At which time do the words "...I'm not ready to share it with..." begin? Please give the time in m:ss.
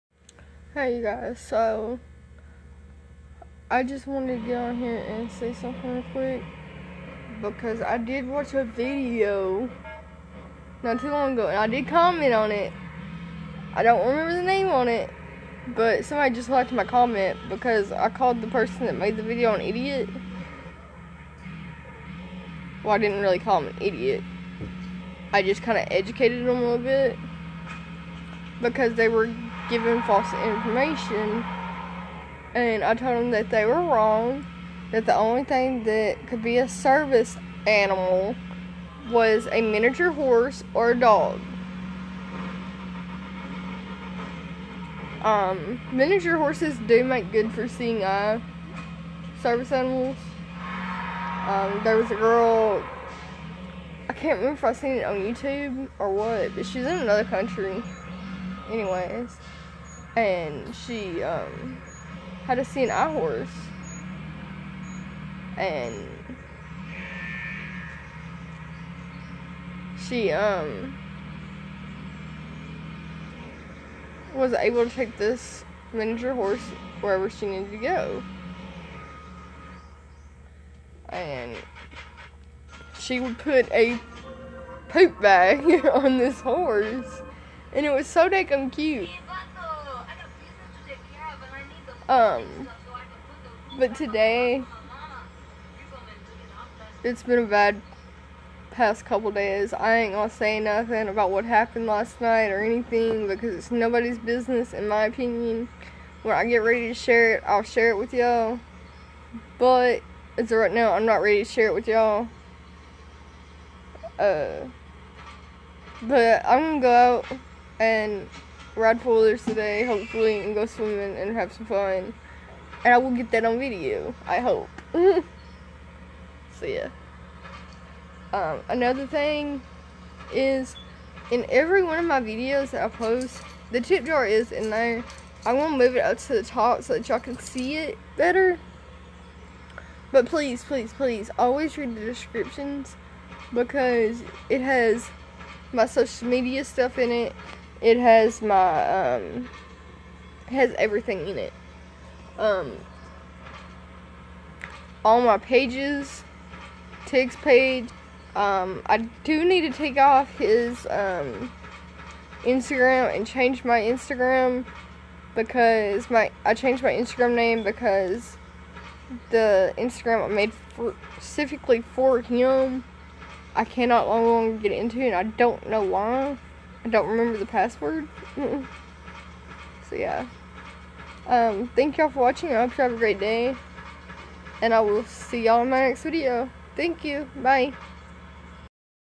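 1:50.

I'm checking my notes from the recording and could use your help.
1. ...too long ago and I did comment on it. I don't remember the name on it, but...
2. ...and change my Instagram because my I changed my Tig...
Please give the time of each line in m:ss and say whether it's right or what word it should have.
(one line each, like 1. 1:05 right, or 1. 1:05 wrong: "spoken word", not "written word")
1. 0:11 right
2. 2:43 wrong: "Instagram", not "Tig".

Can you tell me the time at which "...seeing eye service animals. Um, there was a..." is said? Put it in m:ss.
0:47.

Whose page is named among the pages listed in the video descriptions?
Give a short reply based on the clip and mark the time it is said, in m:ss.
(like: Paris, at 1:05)
Tig, at 2:37.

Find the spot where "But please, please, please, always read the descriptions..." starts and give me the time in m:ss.
2:20.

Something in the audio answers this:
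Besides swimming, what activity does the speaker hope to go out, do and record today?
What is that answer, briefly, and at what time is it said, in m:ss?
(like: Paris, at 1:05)
Ride poolers, at 1:58.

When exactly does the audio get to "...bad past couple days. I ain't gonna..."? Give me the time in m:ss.
1:37.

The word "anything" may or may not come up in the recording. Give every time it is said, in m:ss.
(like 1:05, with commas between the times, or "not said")
1:42.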